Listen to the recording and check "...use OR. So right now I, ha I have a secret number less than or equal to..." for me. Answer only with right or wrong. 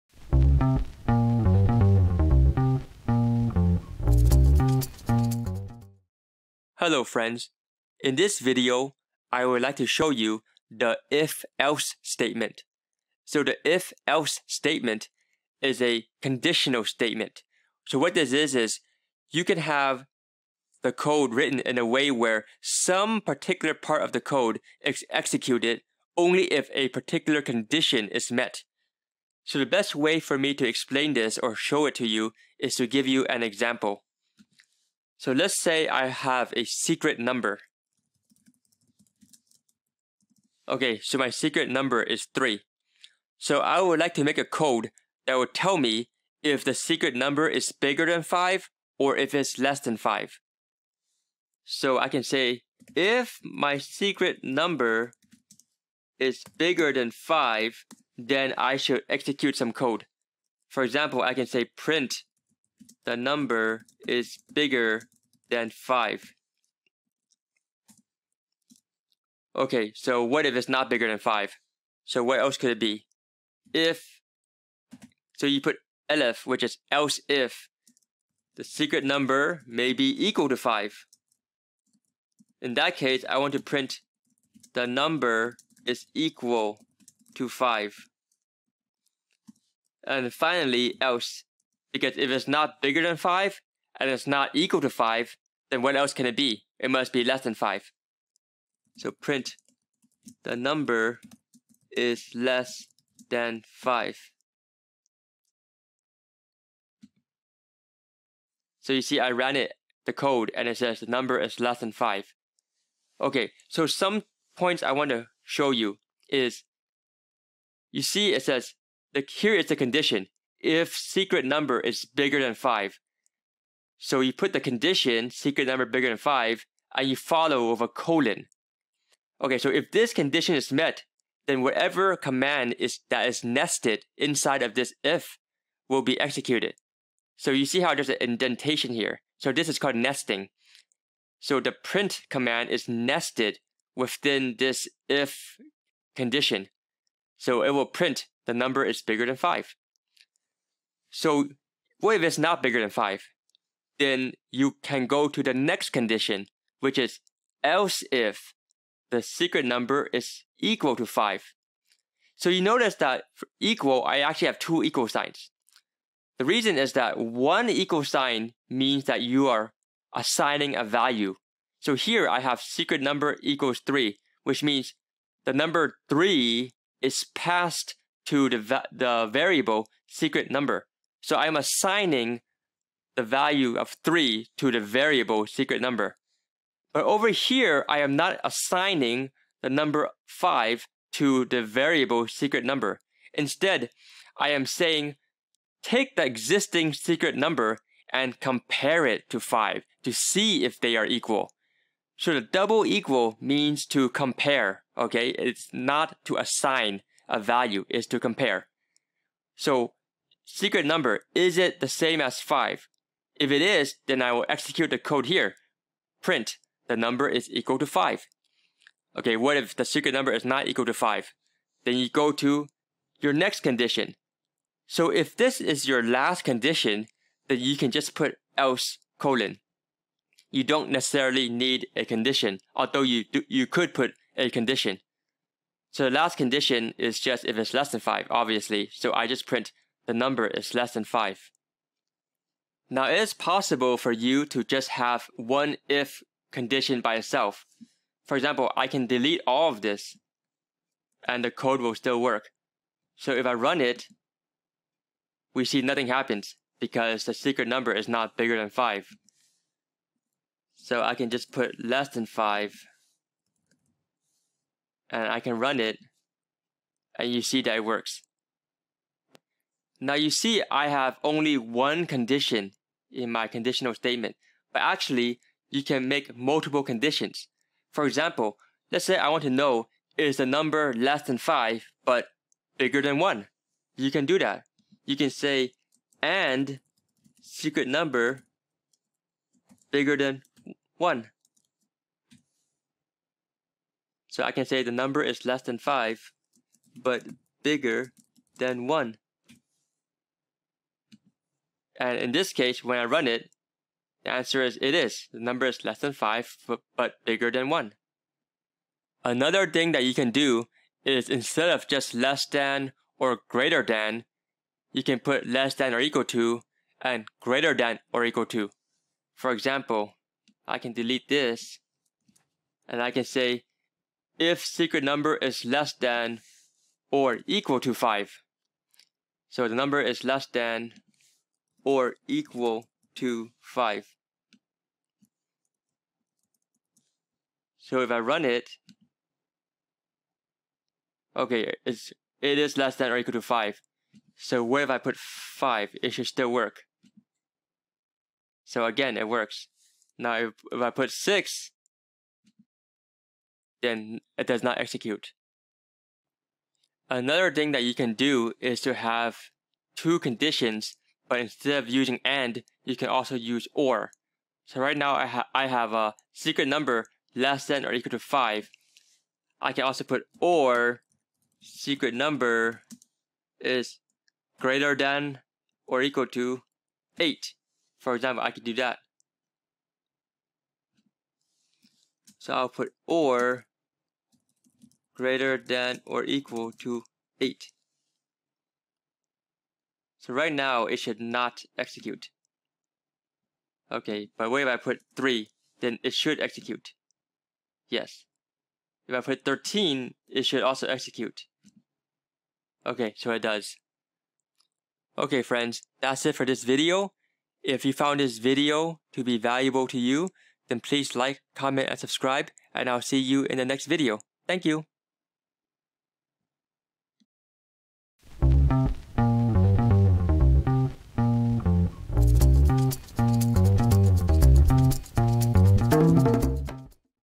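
right.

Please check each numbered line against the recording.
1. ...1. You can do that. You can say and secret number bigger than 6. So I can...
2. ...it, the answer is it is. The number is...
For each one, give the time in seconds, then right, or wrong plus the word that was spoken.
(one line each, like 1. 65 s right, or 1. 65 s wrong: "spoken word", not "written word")
1. 283 s wrong: "1", not "6"
2. 303 s right.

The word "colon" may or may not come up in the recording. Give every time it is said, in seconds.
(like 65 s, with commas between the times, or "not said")
127 s, 229 s.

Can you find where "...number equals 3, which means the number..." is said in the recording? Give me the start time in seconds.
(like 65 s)
173 s.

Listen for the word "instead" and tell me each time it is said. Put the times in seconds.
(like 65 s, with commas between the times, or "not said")
193 s, 311 s, 361 s.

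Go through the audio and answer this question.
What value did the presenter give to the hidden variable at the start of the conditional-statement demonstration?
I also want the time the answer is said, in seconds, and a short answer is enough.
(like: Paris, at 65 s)
3, at 41 s.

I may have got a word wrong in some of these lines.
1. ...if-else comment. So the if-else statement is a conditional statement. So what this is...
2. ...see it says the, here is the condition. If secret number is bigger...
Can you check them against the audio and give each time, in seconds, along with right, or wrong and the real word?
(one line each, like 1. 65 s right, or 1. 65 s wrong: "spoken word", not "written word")
1. 11 s wrong: "statement", not "comment"
2. 118 s right.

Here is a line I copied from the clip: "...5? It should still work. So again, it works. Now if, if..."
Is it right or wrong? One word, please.
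right.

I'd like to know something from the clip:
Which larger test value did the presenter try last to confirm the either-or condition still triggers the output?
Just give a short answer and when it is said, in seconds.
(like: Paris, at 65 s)
13, at 399 s.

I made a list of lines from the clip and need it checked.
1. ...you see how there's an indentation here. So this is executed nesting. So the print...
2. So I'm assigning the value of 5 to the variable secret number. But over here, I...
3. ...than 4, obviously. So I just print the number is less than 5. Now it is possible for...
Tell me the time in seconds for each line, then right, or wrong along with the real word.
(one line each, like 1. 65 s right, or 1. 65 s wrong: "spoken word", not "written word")
1. 137 s wrong: "called", not "executed"
2. 181 s wrong: "3", not "5"
3. 237 s wrong: "5", not "4".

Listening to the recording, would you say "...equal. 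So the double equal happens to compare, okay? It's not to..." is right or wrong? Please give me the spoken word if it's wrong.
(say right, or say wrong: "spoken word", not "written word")
wrong: "means", not "happens".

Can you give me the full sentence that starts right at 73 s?
If, so you put elif, which is else if, the secret number may be equal to 5.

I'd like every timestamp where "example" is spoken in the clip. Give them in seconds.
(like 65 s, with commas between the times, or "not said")
33 s, 60 s, 248 s, 278 s, 319 s, 378 s.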